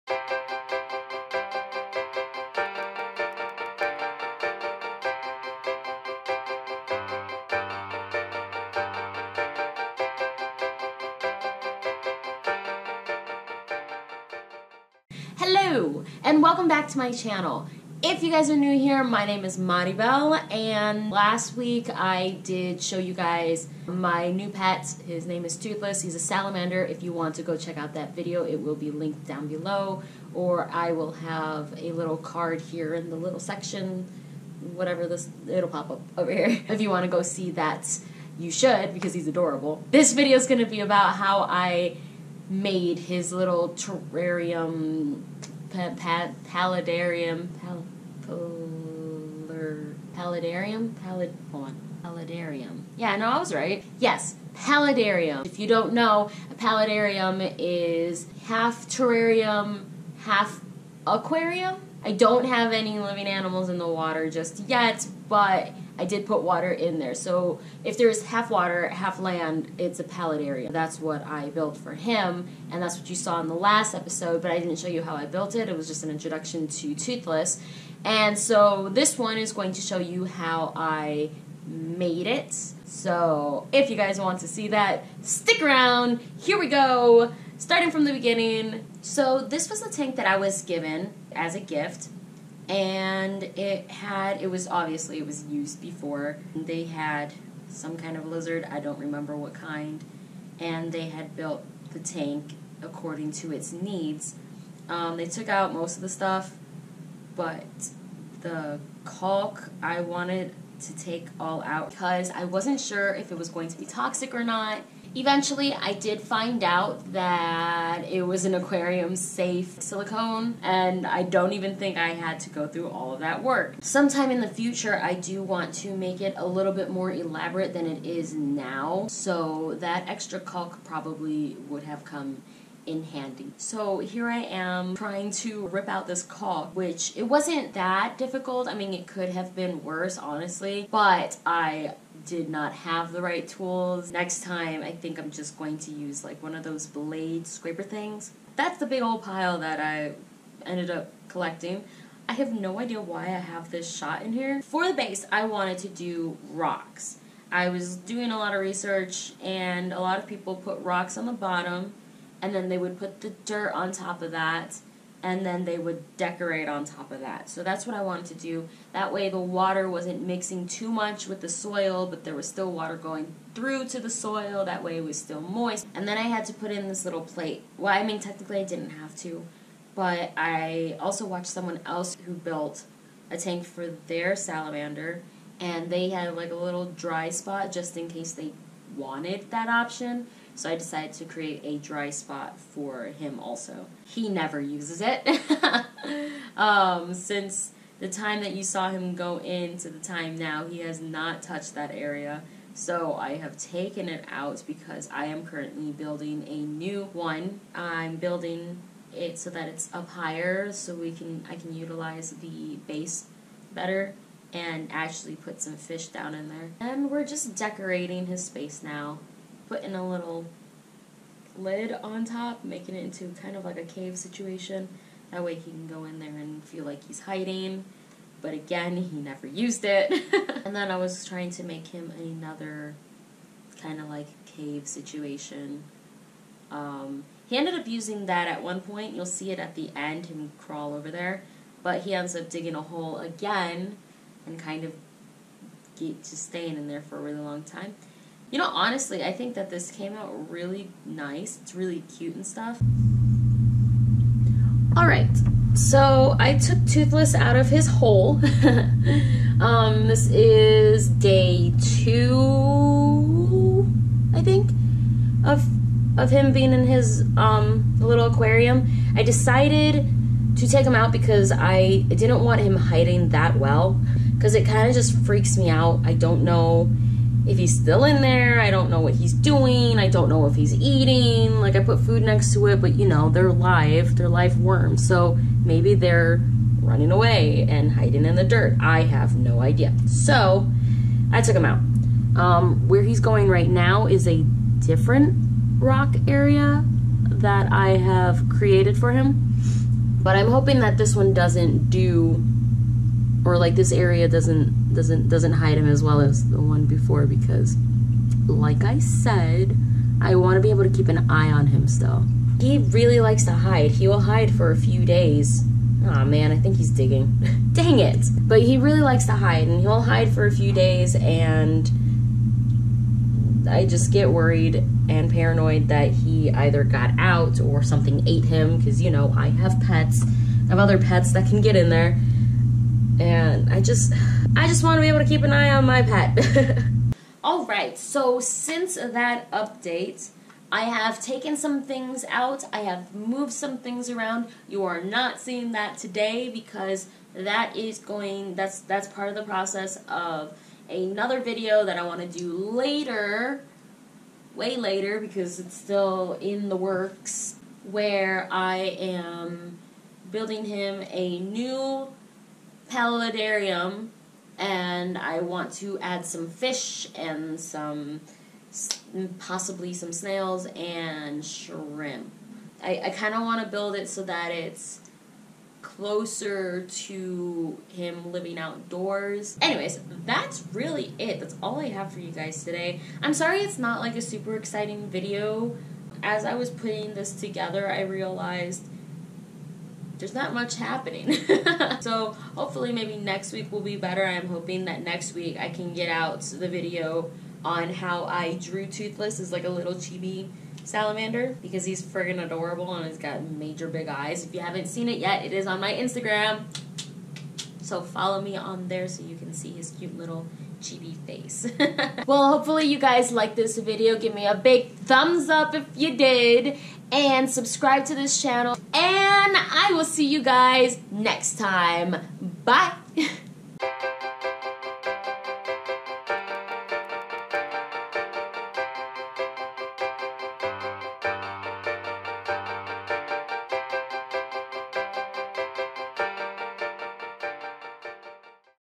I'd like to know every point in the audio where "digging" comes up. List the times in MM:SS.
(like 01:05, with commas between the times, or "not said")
04:02, 05:16.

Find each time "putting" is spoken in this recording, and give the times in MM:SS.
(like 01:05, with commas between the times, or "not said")
03:39, 06:26.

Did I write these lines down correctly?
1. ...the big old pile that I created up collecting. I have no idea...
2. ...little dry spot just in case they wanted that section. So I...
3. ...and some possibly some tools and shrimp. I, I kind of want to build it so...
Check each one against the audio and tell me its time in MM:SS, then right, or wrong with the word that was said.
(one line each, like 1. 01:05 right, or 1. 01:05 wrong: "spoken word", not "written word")
1. 02:28 wrong: "ended", not "created"
2. 03:06 wrong: "option", not "section"
3. 06:07 wrong: "snails", not "tools".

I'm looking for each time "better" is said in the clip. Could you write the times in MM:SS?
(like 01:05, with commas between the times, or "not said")
03:33, 06:33.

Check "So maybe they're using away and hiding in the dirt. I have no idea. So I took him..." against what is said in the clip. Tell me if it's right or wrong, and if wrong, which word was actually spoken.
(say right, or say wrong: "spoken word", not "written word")
wrong: "running", not "using".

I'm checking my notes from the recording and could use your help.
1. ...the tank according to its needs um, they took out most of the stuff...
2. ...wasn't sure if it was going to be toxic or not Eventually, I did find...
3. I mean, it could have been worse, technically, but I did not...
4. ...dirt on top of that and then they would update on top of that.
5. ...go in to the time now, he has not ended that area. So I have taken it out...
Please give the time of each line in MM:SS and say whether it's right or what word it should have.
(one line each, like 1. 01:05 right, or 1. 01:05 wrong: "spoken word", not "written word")
1. 01:41 right
2. 01:52 right
3. 02:18 wrong: "honestly", not "technically"
4. 02:43 wrong: "decorate", not "update"
5. 03:19 wrong: "touched", not "ended".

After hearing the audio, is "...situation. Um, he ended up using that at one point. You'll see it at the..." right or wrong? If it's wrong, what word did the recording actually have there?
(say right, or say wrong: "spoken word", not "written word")
right.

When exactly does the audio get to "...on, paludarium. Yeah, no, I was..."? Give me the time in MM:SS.
00:51.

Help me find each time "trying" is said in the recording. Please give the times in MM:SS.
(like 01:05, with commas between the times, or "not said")
02:14, 03:51.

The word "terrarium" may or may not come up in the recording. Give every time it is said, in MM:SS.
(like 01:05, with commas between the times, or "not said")
00:43, 00:58.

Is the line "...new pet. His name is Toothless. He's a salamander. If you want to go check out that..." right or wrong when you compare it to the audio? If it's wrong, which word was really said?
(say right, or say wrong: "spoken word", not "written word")
right.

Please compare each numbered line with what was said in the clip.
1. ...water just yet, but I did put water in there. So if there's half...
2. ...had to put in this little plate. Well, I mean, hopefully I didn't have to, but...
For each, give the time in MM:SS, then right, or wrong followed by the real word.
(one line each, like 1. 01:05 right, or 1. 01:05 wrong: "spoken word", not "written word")
1. 01:03 right
2. 02:56 wrong: "technically", not "hopefully".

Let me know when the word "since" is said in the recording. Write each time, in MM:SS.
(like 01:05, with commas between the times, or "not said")
03:17, 05:38.